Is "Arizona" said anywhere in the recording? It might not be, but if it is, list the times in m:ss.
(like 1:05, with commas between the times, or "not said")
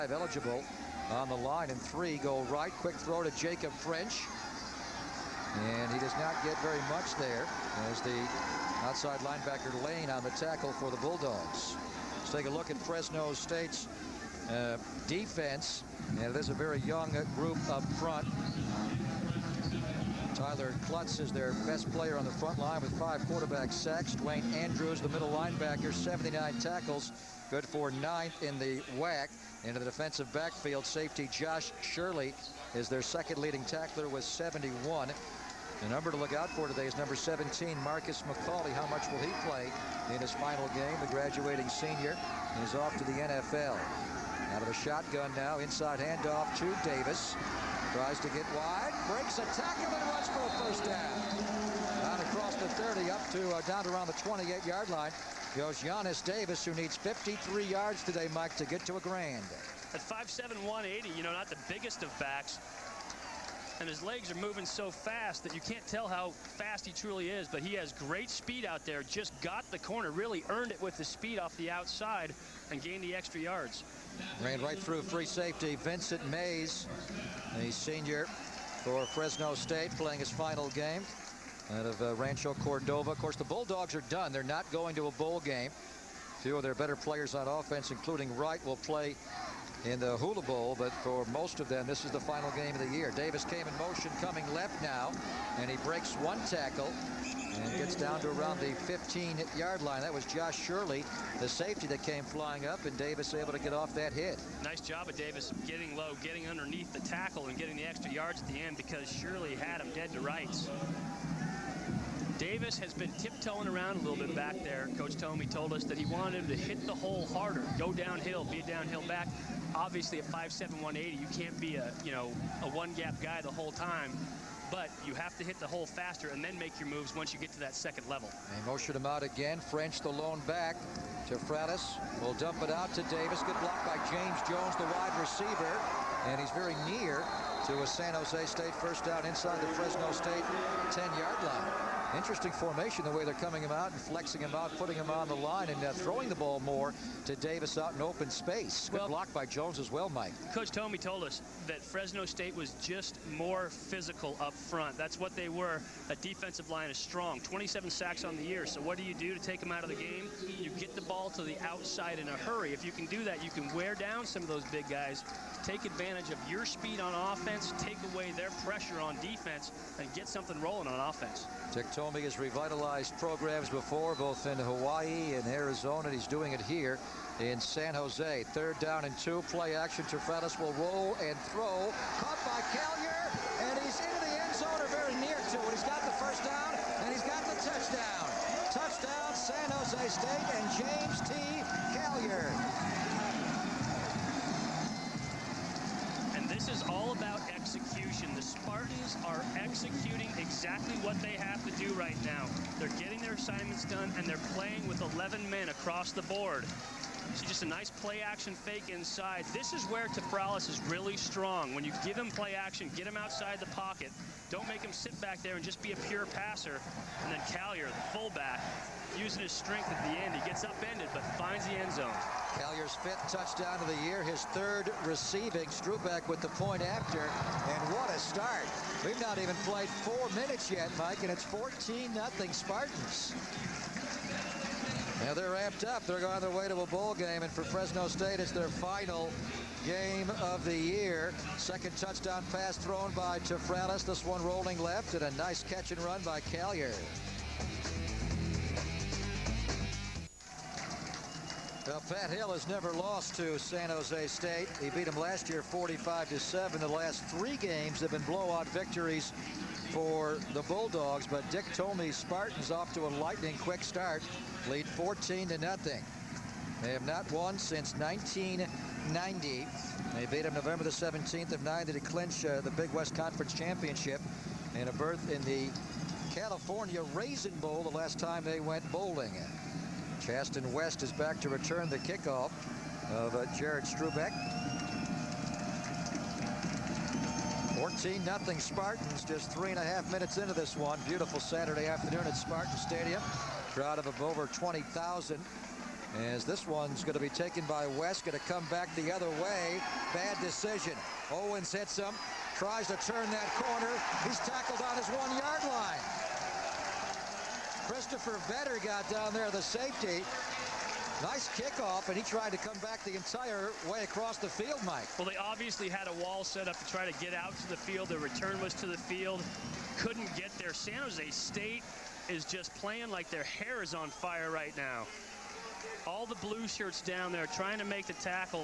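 2:55.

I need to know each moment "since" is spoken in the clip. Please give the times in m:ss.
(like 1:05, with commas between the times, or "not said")
4:27.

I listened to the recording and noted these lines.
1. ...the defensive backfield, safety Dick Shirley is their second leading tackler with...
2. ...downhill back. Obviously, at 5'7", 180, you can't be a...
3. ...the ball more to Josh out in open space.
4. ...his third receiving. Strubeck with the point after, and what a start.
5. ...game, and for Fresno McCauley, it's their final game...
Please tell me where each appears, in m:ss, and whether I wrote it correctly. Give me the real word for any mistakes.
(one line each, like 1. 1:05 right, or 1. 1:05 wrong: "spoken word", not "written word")
1. 0:29 wrong: "Josh", not "Dick"
2. 1:58 right
3. 2:26 wrong: "Davis", not "Josh"
4. 3:44 right
5. 3:57 wrong: "State", not "McCauley".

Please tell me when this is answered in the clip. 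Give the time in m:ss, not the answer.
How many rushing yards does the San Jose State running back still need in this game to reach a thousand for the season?
0:56.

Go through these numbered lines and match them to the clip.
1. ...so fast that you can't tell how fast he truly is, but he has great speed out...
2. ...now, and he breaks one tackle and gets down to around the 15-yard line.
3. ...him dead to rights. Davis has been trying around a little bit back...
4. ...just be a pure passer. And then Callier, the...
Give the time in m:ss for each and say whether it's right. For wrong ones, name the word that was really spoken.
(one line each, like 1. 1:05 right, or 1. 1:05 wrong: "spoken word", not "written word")
1. 1:04 right
2. 1:34 right
3. 1:49 wrong: "tiptoeing", not "trying"
4. 3:35 right.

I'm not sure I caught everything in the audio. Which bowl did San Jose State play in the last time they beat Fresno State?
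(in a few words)
California Raisin Bowl.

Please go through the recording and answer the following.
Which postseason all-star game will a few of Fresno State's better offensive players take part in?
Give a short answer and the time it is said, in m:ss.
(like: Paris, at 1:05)
Hula Bowl, at 1:30.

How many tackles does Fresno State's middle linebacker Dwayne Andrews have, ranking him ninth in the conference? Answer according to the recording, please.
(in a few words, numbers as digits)
79.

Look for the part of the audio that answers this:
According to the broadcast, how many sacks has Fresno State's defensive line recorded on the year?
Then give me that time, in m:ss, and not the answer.
2:37.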